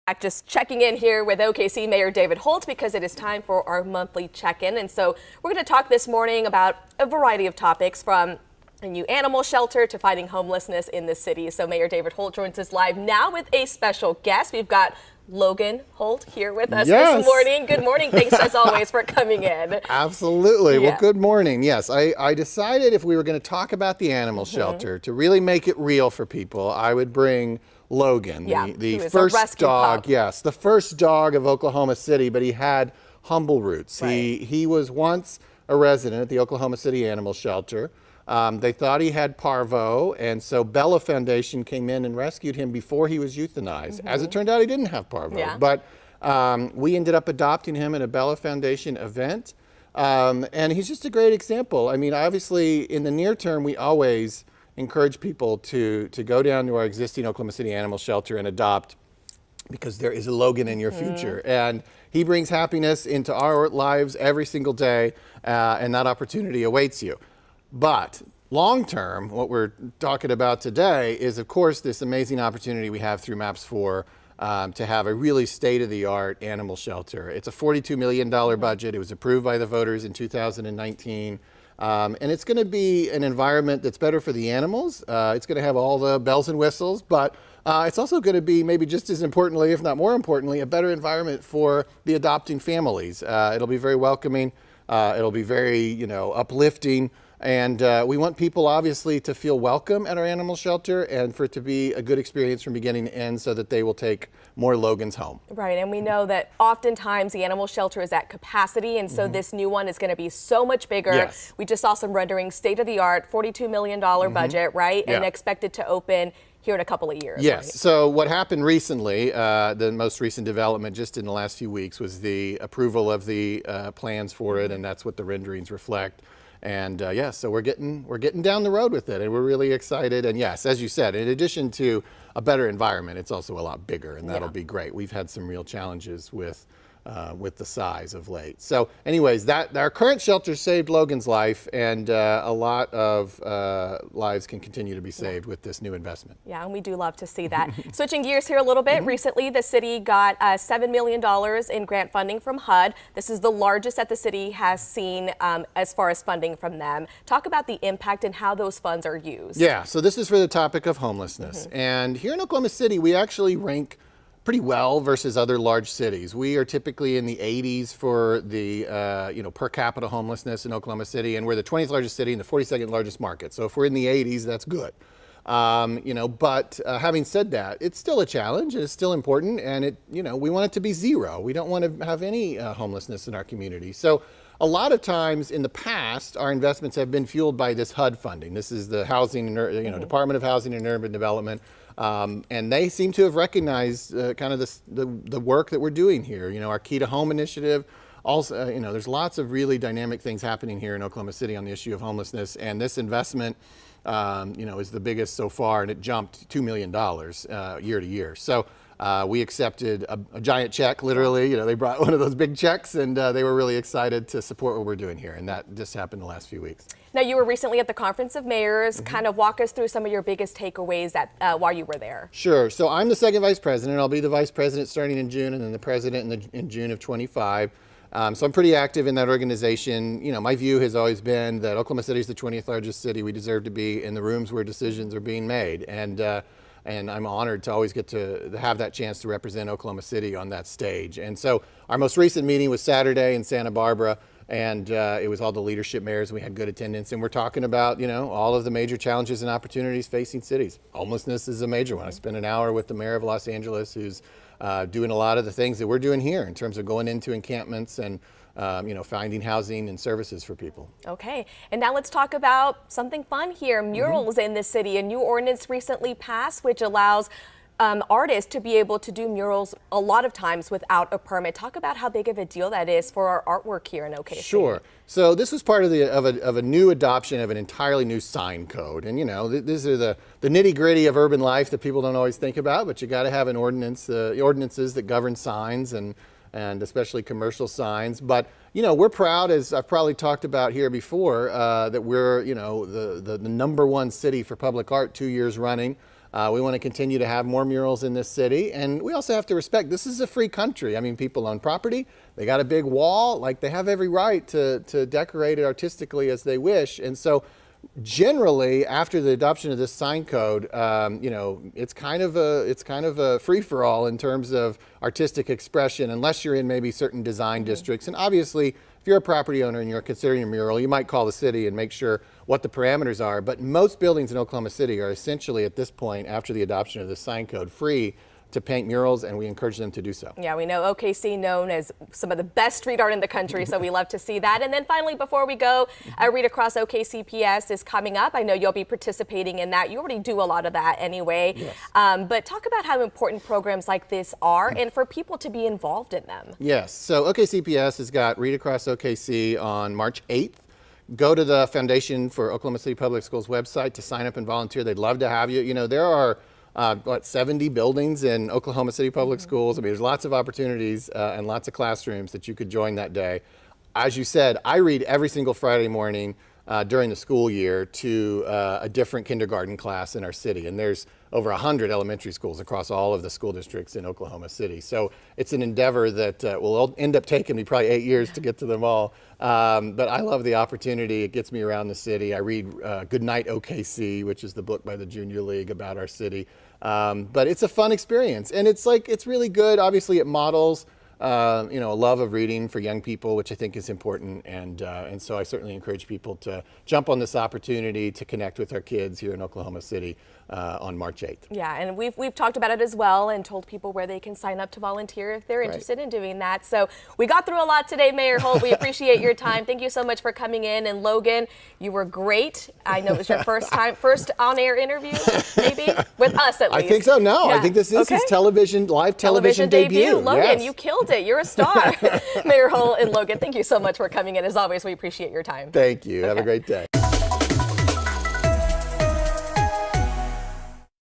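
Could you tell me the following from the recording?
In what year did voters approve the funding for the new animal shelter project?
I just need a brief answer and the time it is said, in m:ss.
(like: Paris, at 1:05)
2019, at 1:20.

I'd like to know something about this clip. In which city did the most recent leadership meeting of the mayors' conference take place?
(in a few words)
Santa Barbara.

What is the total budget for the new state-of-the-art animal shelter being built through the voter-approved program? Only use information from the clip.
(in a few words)
$42 million.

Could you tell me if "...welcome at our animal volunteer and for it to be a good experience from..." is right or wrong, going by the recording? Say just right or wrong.
wrong.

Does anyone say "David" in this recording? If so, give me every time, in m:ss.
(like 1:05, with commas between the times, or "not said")
0:02, 0:11.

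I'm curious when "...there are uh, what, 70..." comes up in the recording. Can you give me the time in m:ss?
5:55.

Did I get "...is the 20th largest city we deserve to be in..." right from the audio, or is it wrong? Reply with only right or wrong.
right.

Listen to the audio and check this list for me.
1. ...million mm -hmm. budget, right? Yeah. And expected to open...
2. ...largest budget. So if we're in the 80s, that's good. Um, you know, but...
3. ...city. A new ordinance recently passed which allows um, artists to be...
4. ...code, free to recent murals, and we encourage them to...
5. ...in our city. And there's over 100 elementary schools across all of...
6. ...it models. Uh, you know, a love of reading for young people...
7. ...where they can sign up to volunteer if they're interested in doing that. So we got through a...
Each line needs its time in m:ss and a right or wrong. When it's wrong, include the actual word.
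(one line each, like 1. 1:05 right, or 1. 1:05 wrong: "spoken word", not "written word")
1. 1:53 right
2. 2:52 wrong: "market", not "budget"
3. 4:24 right
4. 5:27 wrong: "paint", not "recent"
5. 6:10 right
6. 6:30 right
7. 6:43 right.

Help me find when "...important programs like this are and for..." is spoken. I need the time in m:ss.
5:43.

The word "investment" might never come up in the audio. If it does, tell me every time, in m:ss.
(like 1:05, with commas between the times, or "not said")
2:25, 3:06, 3:22.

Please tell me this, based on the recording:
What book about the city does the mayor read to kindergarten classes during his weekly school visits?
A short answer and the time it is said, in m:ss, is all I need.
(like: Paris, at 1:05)
Goodnight OKC, at 6:23.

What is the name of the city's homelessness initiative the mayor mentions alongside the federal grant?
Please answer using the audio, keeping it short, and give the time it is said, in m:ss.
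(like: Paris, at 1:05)
Key to Home, at 3:16.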